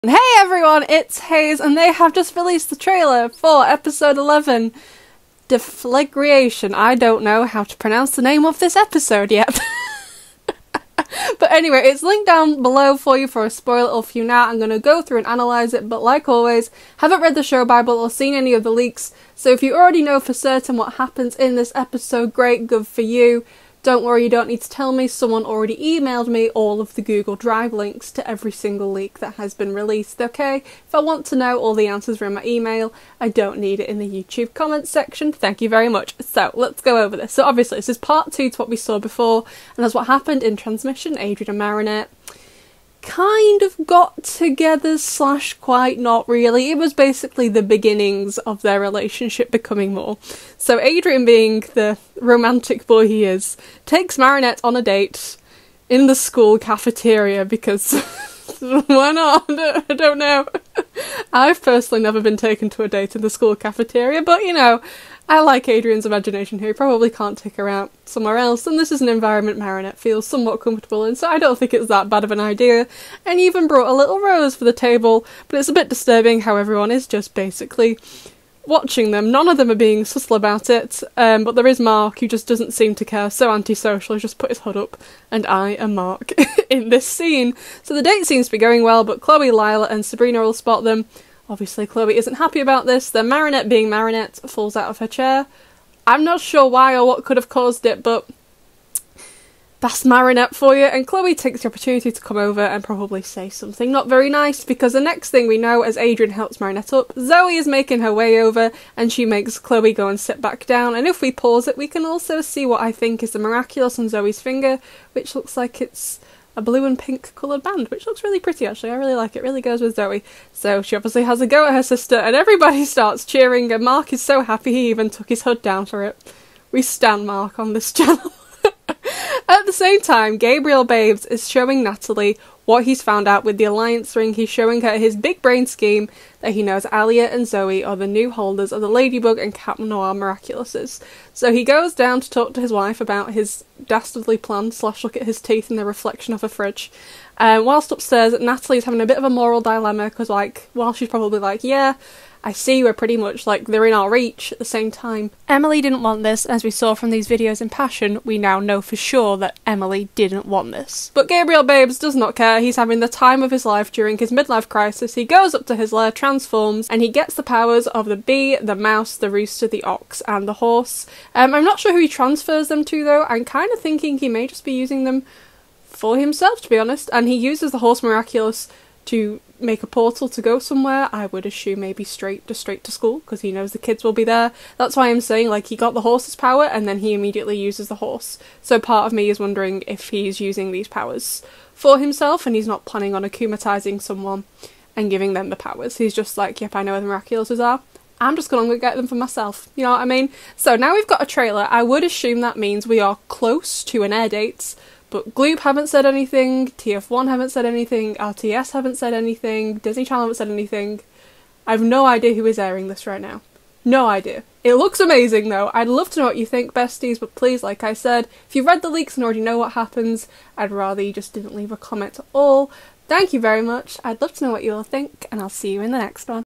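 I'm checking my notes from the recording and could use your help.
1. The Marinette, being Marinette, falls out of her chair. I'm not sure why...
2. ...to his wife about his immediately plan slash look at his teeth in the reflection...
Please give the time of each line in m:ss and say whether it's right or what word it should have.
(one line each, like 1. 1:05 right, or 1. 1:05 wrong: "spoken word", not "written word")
1. 1:33 right
2. 2:22 wrong: "dastardly", not "immediately".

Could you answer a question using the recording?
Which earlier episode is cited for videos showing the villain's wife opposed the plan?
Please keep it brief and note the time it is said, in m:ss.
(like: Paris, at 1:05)
Passion, at 2:37.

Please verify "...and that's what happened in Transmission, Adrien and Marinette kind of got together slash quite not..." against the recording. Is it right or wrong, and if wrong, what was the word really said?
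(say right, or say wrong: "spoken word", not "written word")
right.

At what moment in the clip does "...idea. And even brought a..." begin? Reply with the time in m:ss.
1:12.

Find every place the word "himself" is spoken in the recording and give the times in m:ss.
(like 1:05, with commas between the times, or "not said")
2:56, 3:11.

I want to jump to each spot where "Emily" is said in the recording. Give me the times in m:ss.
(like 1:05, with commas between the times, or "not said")
2:35, 2:39.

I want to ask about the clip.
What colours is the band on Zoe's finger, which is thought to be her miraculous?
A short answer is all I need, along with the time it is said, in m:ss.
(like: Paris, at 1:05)
Blue and pink, at 1:56.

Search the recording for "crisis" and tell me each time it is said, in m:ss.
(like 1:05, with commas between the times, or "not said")
2:44.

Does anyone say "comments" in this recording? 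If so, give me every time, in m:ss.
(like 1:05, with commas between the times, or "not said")
0:34, 3:41.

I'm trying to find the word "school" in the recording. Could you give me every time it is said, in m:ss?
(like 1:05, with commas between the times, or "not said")
0:56, 1:03, 3:02.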